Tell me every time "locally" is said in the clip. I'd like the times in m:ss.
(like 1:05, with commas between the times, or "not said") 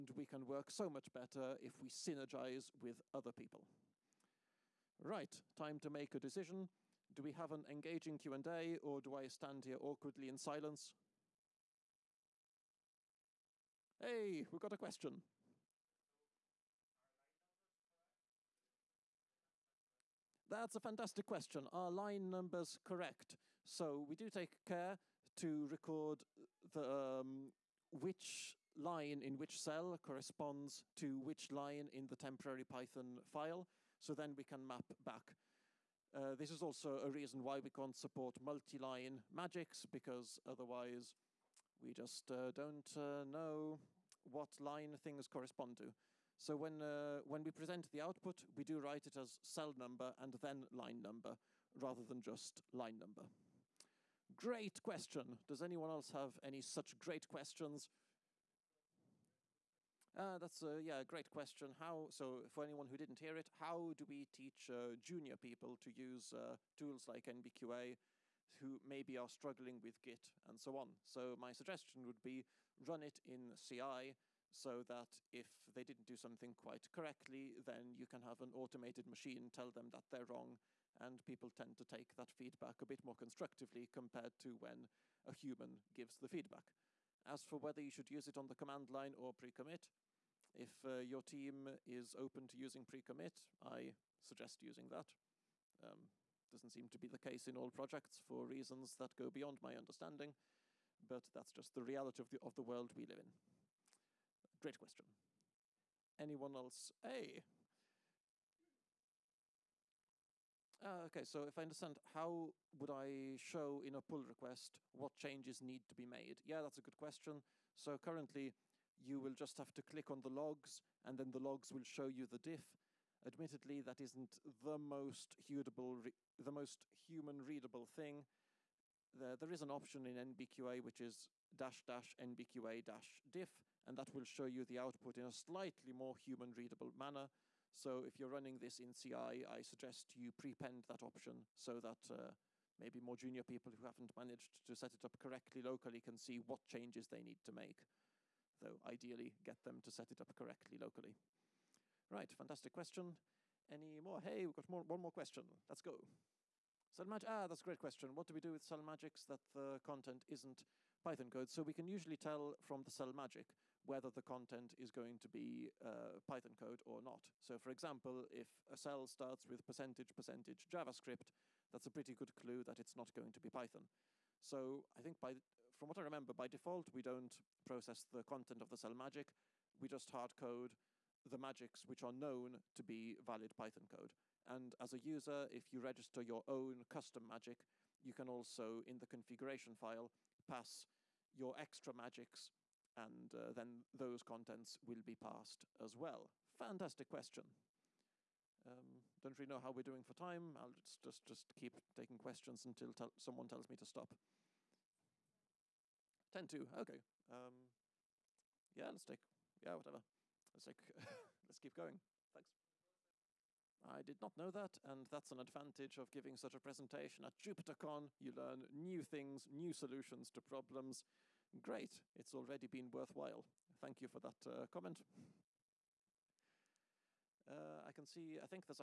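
2:25, 2:30.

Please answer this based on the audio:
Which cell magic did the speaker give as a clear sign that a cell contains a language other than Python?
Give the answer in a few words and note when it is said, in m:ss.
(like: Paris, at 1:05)
%%javascript, at 2:49.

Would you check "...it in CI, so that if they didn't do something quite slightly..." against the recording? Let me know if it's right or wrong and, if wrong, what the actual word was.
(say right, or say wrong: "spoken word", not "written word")
wrong: "correctly", not "slightly".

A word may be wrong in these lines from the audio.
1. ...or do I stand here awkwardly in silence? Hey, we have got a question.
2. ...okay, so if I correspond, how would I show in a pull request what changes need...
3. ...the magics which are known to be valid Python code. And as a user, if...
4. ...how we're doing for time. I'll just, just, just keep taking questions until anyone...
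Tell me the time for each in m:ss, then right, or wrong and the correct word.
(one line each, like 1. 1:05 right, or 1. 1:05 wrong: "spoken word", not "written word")
1. 0:08 right
2. 1:51 wrong: "understand", not "correspond"
3. 3:01 right
4. 3:19 wrong: "someone", not "anyone".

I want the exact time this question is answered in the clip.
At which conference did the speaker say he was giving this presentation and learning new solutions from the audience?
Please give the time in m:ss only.
3:37.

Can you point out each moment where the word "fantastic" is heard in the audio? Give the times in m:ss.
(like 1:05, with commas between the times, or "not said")
0:20, 2:32, 3:16.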